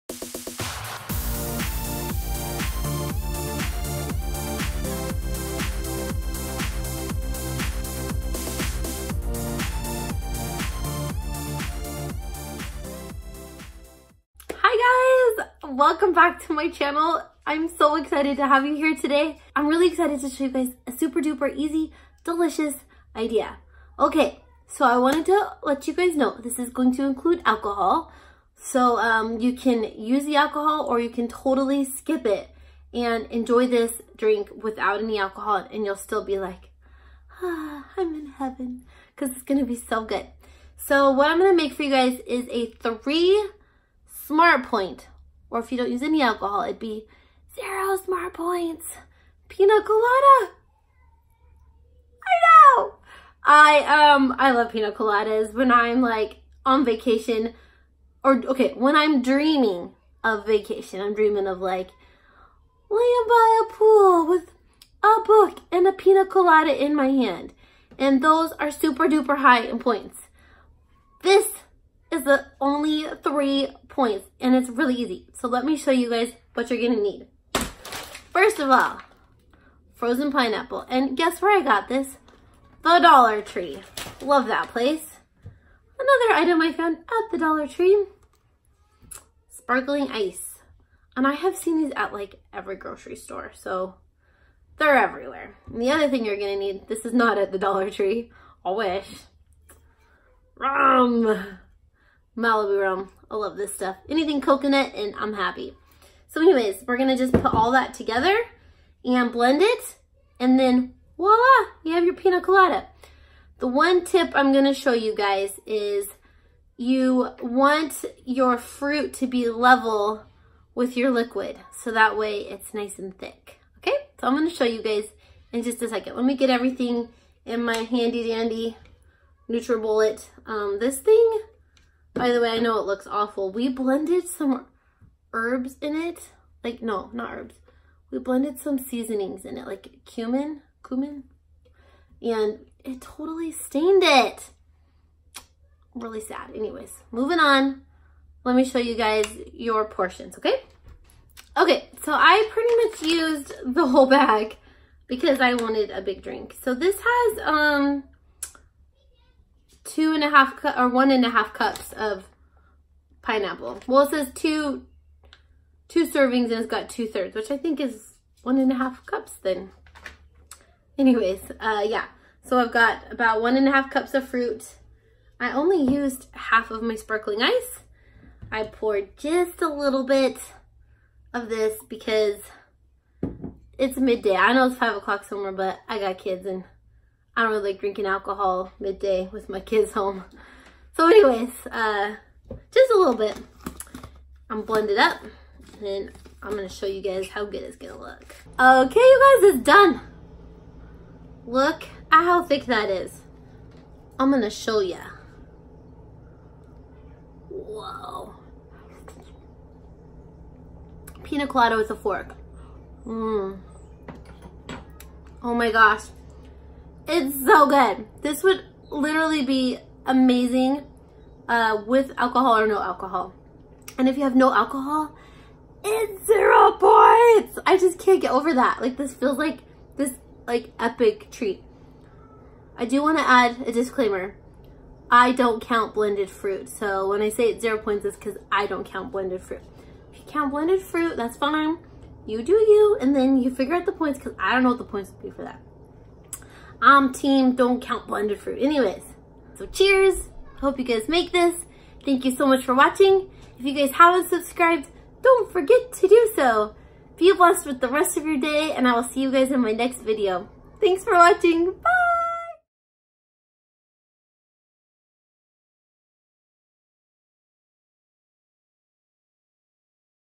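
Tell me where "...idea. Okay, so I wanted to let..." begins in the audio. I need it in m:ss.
0:23.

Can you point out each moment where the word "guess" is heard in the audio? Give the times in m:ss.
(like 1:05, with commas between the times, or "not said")
1:21.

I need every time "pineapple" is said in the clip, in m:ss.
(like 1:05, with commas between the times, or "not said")
1:20, 2:43.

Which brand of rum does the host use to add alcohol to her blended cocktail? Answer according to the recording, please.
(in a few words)
Malibu.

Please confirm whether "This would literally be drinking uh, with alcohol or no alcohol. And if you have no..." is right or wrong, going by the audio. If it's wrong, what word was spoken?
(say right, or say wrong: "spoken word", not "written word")
wrong: "amazing", not "drinking".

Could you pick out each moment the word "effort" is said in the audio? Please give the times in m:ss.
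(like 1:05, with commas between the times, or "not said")
not said.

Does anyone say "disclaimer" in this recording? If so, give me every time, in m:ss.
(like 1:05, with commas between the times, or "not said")
3:53.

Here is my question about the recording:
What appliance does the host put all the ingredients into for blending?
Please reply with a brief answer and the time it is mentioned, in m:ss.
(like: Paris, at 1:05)
NutriBullet, at 2:09.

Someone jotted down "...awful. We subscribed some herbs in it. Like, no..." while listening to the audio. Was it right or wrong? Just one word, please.
wrong.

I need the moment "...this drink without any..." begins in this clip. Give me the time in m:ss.
0:33.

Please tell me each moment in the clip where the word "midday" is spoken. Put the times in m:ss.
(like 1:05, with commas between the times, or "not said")
3:03, 3:08.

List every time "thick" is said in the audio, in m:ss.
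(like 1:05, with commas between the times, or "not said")
2:03, 3:22.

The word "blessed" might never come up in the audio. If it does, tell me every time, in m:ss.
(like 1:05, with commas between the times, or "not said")
4:17.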